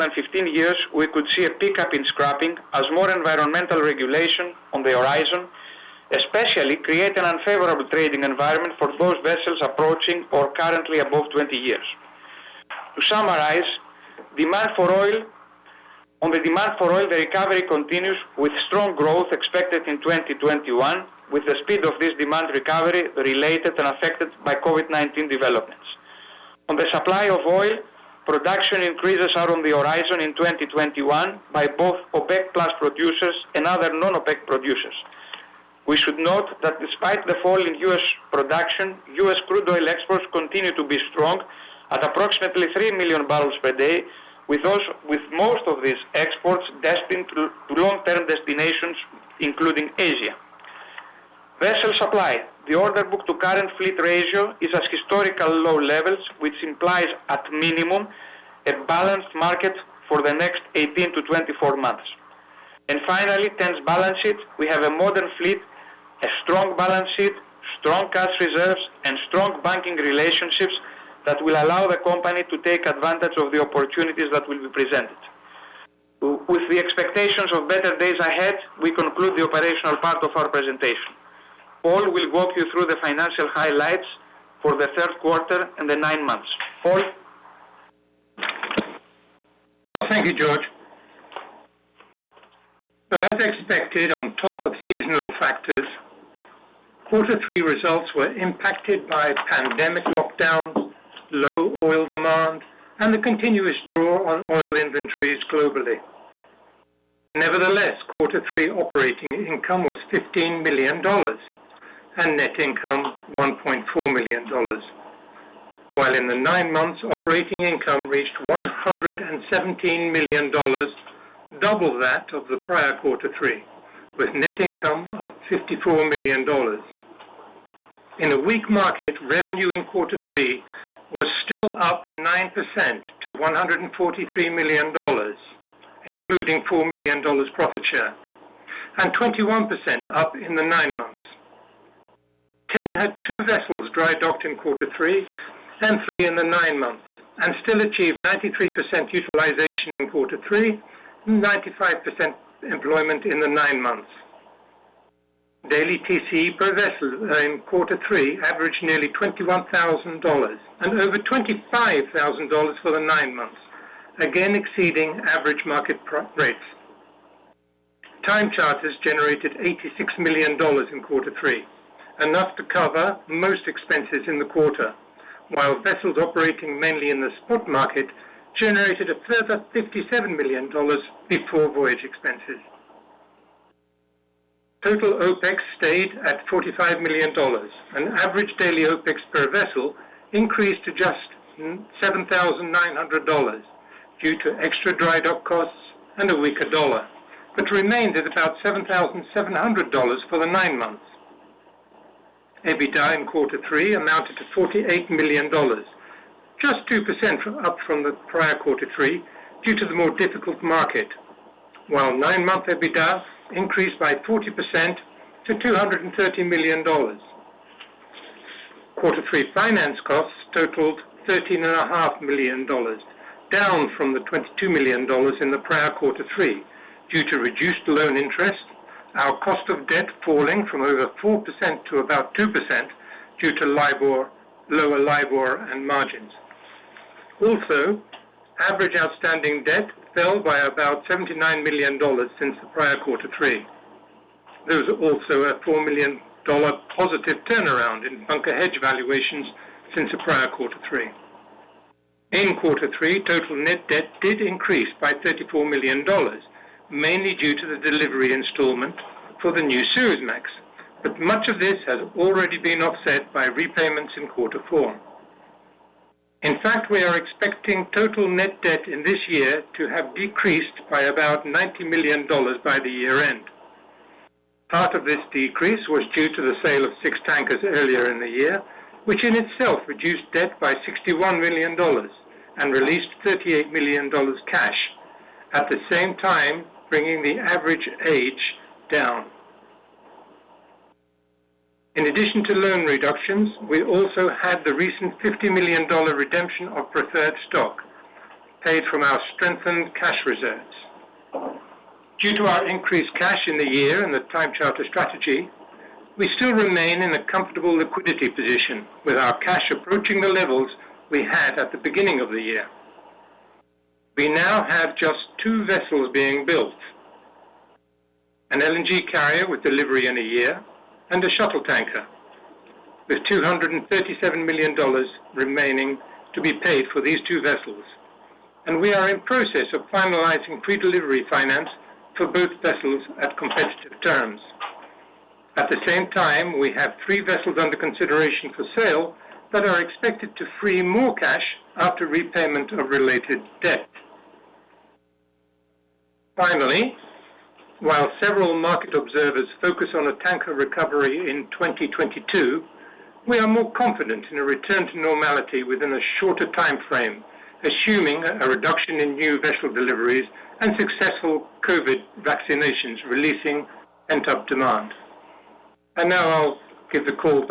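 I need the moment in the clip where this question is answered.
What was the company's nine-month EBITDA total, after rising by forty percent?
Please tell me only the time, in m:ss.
3:35.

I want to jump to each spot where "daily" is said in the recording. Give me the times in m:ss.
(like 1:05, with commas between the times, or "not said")
2:35, 3:08.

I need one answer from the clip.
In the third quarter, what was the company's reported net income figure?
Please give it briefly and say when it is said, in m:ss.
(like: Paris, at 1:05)
$1.4 million, at 1:53.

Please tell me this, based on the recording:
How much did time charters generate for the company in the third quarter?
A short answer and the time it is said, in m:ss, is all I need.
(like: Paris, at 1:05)
$86 million, at 2:49.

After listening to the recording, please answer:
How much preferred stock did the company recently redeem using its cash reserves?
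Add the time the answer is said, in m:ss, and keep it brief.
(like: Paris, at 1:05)
$50 million, at 4:55.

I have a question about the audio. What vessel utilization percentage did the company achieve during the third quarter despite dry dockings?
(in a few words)
93%.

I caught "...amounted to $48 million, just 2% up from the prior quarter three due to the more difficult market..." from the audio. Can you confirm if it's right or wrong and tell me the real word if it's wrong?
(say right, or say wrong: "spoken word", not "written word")
right.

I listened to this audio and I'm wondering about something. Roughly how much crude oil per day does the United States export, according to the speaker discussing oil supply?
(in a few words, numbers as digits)
3 million barrels.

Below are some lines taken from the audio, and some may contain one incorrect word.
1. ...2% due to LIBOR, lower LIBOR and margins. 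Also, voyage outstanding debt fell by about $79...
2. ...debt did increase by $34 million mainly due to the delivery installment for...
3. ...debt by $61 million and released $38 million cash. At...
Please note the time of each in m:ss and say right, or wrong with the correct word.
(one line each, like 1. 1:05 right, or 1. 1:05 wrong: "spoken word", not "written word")
1. 3:52 wrong: "average", not "voyage"
2. 4:13 right
3. 4:40 right.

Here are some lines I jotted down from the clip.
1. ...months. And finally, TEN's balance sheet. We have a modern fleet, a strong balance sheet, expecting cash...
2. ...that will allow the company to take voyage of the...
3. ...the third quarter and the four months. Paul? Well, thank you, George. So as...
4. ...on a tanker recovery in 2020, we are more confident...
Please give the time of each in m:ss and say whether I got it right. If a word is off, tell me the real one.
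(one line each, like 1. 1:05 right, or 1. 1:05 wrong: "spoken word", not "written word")
1. 1:01 wrong: "strong", not "expecting"
2. 1:11 wrong: "advantage", not "voyage"
3. 1:24 wrong: "nine", not "four"
4. 5:49 wrong: "2022", not "2020".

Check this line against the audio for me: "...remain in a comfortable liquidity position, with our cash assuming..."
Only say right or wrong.
wrong.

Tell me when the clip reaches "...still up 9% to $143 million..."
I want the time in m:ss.
2:11.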